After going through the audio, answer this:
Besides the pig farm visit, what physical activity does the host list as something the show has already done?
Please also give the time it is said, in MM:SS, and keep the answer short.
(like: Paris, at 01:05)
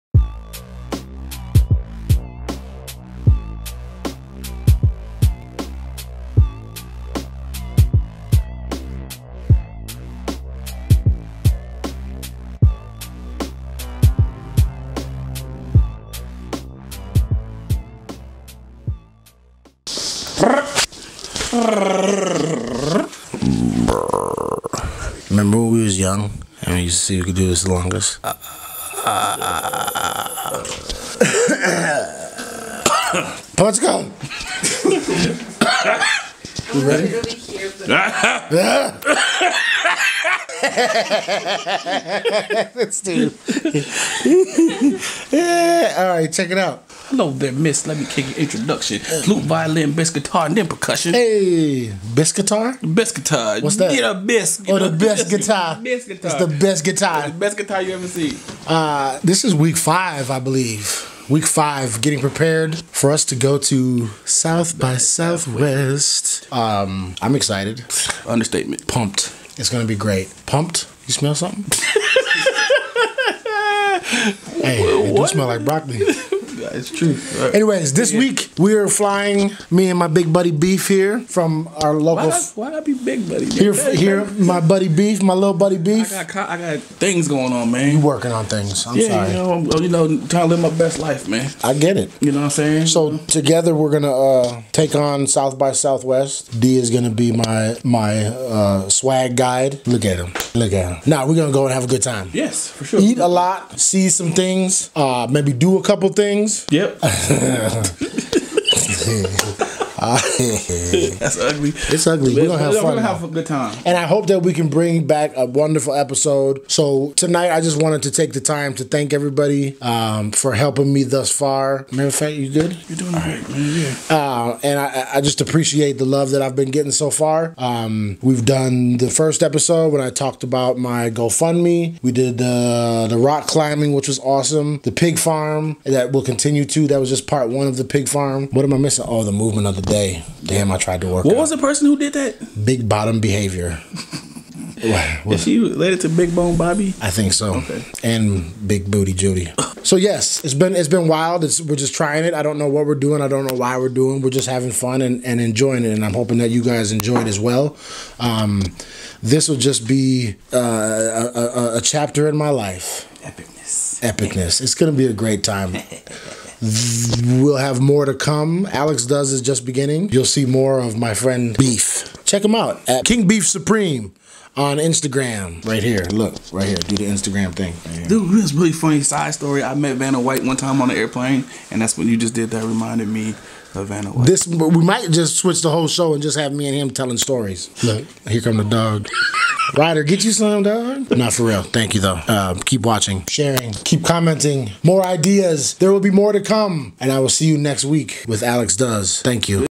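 Rock climbing, at 02:13.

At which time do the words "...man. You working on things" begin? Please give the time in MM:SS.
01:27.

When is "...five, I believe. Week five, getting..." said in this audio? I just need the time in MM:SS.
00:59.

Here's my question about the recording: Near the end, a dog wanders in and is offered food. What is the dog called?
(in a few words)
Ryder.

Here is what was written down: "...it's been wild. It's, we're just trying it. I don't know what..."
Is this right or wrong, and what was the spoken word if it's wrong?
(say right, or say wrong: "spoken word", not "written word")
right.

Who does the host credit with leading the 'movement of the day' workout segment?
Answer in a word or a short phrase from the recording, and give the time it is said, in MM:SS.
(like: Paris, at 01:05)
Big Bottom Behavior, at 02:22.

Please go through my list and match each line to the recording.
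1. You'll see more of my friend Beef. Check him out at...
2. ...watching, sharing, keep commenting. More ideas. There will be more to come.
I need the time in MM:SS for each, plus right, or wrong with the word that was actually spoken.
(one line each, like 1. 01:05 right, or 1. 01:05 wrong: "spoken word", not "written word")
1. 02:50 right
2. 03:12 right.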